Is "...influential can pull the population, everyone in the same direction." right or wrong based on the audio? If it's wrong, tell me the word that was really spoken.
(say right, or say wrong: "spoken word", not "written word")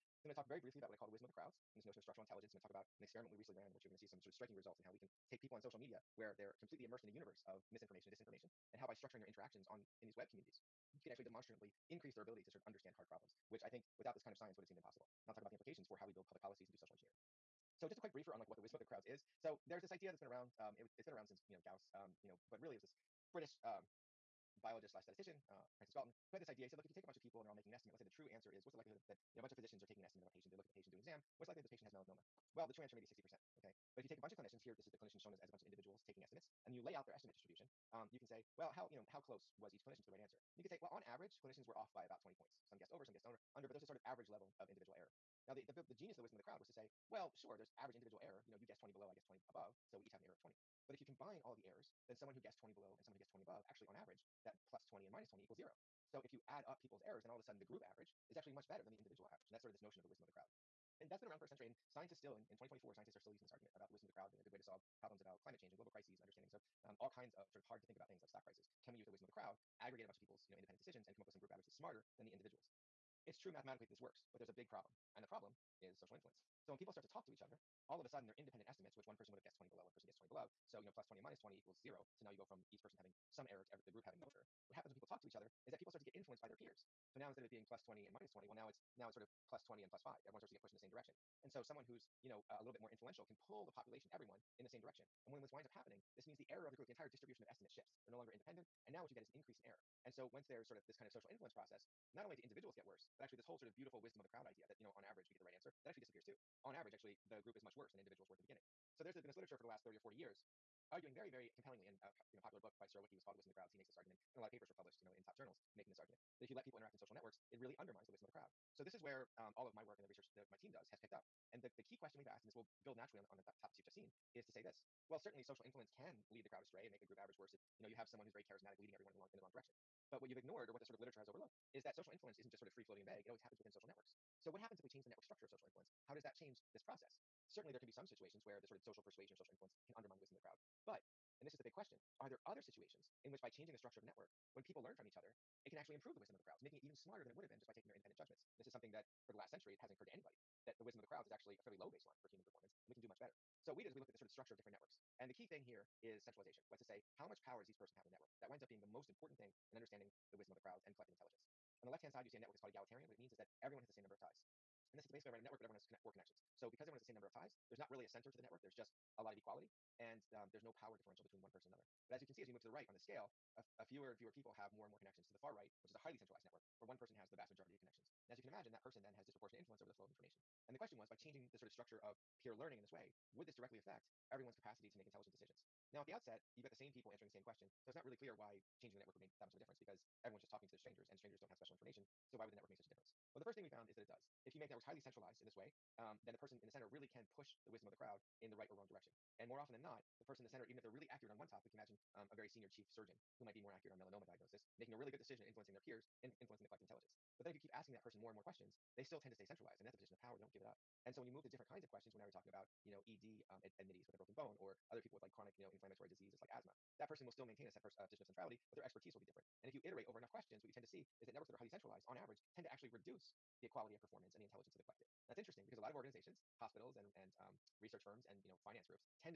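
right.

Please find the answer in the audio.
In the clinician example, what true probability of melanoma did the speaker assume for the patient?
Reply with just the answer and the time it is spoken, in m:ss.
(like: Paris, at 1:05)
60%, at 0:33.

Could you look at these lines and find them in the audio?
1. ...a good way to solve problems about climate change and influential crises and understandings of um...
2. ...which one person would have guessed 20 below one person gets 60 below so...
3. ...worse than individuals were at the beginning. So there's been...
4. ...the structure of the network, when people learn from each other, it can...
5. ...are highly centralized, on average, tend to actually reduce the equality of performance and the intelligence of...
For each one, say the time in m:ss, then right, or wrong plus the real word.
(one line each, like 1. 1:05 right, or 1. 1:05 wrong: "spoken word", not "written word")
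1. 1:04 wrong: "global", not "influential"
2. 1:18 wrong: "20", not "60"
3. 1:47 right
4. 2:23 right
5. 3:41 right.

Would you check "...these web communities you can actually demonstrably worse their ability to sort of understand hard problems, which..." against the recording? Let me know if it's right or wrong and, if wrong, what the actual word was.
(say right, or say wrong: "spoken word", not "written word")
wrong: "increase", not "worse".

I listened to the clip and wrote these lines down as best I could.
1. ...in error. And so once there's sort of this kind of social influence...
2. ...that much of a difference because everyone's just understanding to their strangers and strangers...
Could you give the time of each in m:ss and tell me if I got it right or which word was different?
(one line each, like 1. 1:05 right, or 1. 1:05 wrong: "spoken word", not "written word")
1. 1:39 right
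2. 3:09 wrong: "talking", not "understanding".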